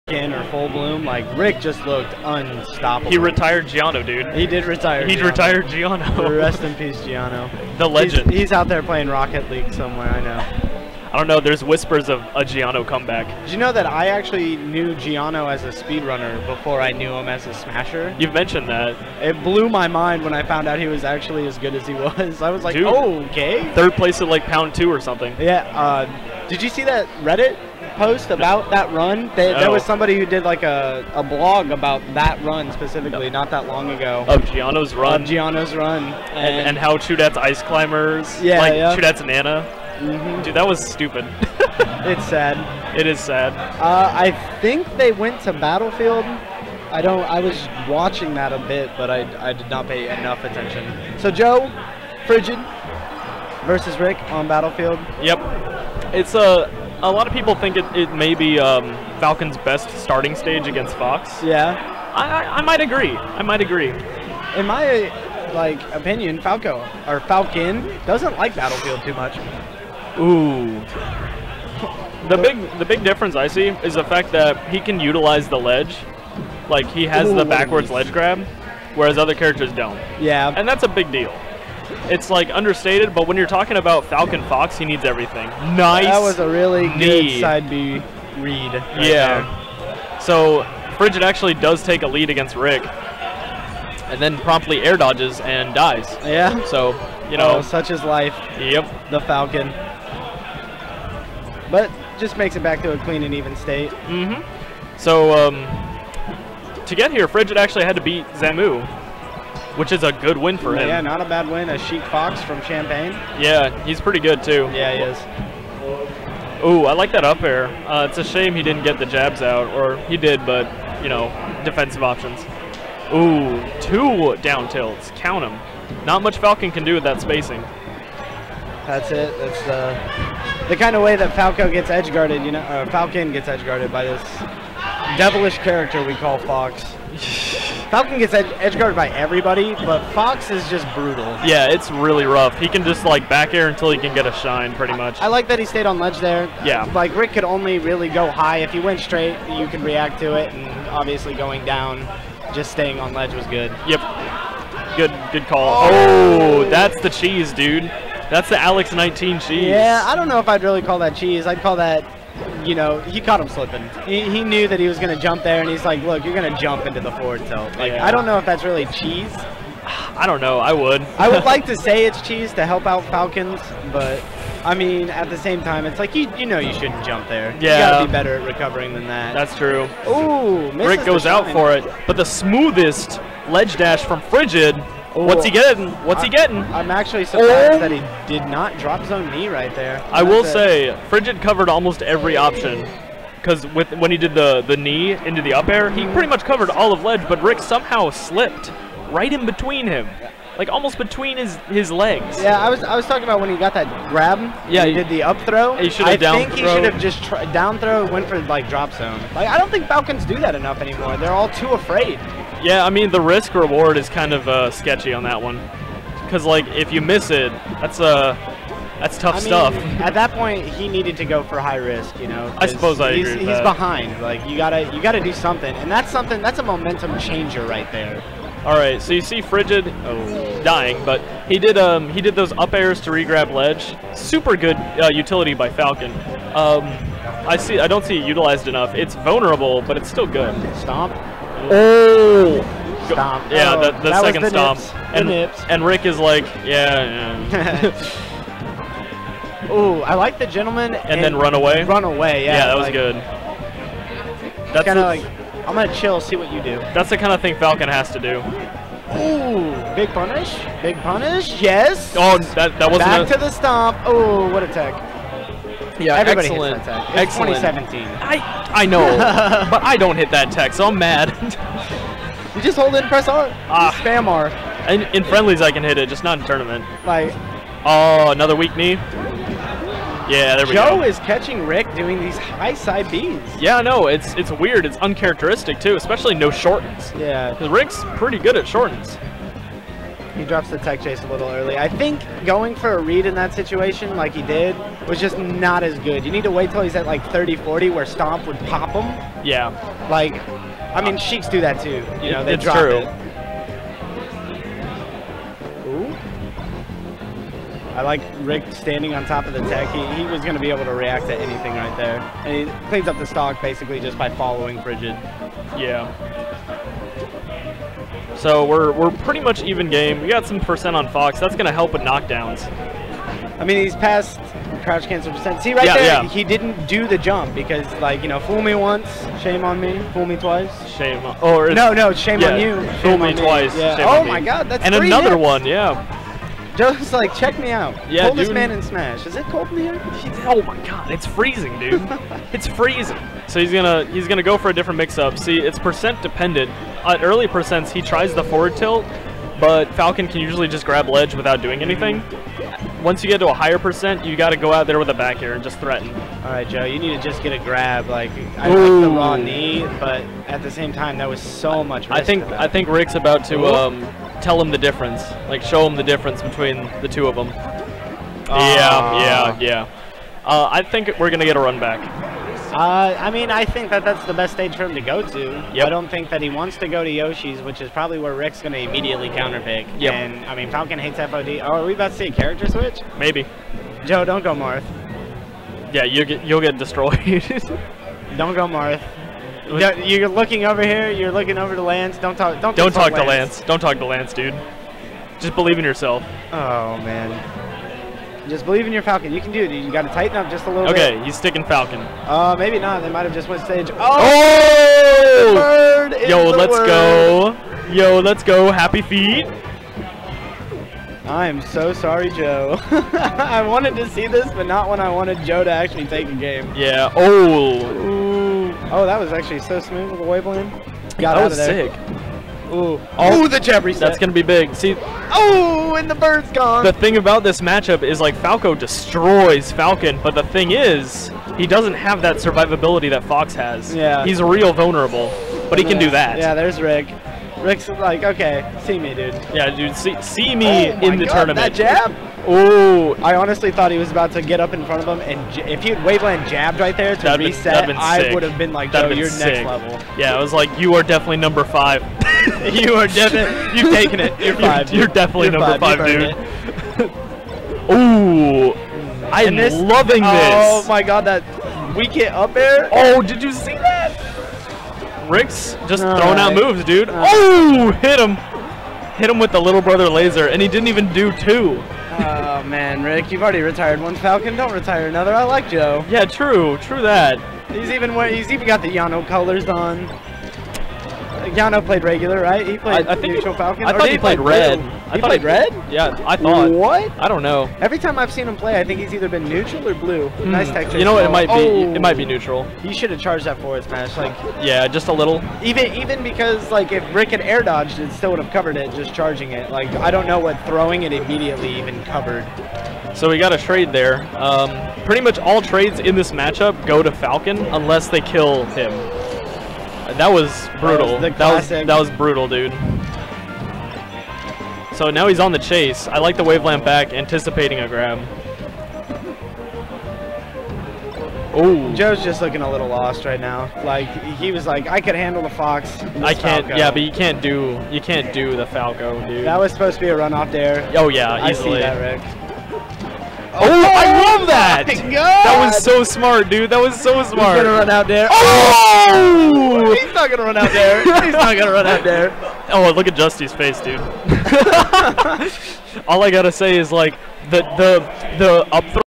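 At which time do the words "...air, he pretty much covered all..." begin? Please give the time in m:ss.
3:15.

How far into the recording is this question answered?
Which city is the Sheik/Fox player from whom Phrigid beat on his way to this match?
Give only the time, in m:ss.
1:52.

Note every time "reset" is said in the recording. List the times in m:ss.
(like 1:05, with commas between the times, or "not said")
7:03, 7:27.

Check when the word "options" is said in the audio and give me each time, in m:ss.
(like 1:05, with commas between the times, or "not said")
2:02, 3:12.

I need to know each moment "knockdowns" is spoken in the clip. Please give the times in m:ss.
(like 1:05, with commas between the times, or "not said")
5:22.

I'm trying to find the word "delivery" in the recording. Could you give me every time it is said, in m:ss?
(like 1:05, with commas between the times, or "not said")
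not said.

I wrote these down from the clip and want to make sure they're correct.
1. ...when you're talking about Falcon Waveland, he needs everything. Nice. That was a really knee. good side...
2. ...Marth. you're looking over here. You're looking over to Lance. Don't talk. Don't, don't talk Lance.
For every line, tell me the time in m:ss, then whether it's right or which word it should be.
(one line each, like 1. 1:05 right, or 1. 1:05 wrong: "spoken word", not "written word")
1. 1:23 wrong: "Fox", not "Waveland"
2. 6:28 right.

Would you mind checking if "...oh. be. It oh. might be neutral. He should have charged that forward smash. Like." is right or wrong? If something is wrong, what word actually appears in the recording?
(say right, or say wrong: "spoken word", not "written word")
right.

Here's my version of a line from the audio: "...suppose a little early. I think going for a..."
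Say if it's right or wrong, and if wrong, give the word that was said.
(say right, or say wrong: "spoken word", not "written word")
wrong: "chase", not "suppose".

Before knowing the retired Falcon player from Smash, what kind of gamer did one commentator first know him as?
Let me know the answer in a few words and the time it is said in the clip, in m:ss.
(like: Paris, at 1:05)
speedrunner, at 0:15.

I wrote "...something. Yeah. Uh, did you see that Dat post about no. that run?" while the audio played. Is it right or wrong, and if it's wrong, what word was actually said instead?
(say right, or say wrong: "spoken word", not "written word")
wrong: "Reddit", not "Dat".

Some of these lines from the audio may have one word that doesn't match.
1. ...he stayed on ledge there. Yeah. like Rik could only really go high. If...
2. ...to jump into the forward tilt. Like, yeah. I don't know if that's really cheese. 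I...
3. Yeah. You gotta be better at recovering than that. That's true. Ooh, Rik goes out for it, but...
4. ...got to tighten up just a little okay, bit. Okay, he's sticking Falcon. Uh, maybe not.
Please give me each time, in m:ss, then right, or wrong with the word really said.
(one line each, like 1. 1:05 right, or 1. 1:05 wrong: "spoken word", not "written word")
1. 2:25 right
2. 2:46 right
3. 2:57 right
4. 6:39 right.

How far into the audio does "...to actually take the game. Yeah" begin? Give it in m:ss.
6:55.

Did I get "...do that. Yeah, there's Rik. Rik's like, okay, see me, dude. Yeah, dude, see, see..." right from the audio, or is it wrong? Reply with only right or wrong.
right.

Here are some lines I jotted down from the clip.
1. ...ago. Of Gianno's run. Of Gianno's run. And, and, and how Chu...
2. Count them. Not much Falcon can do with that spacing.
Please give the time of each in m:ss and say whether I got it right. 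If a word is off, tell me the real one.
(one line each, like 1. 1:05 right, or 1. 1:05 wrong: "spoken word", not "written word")
1. 0:33 right
2. 2:05 right.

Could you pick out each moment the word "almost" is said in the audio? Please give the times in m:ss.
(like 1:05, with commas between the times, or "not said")
3:11, 3:20.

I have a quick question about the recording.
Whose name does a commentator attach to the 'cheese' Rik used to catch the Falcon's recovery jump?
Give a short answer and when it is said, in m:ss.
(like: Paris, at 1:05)
Alex 19, at 2:38.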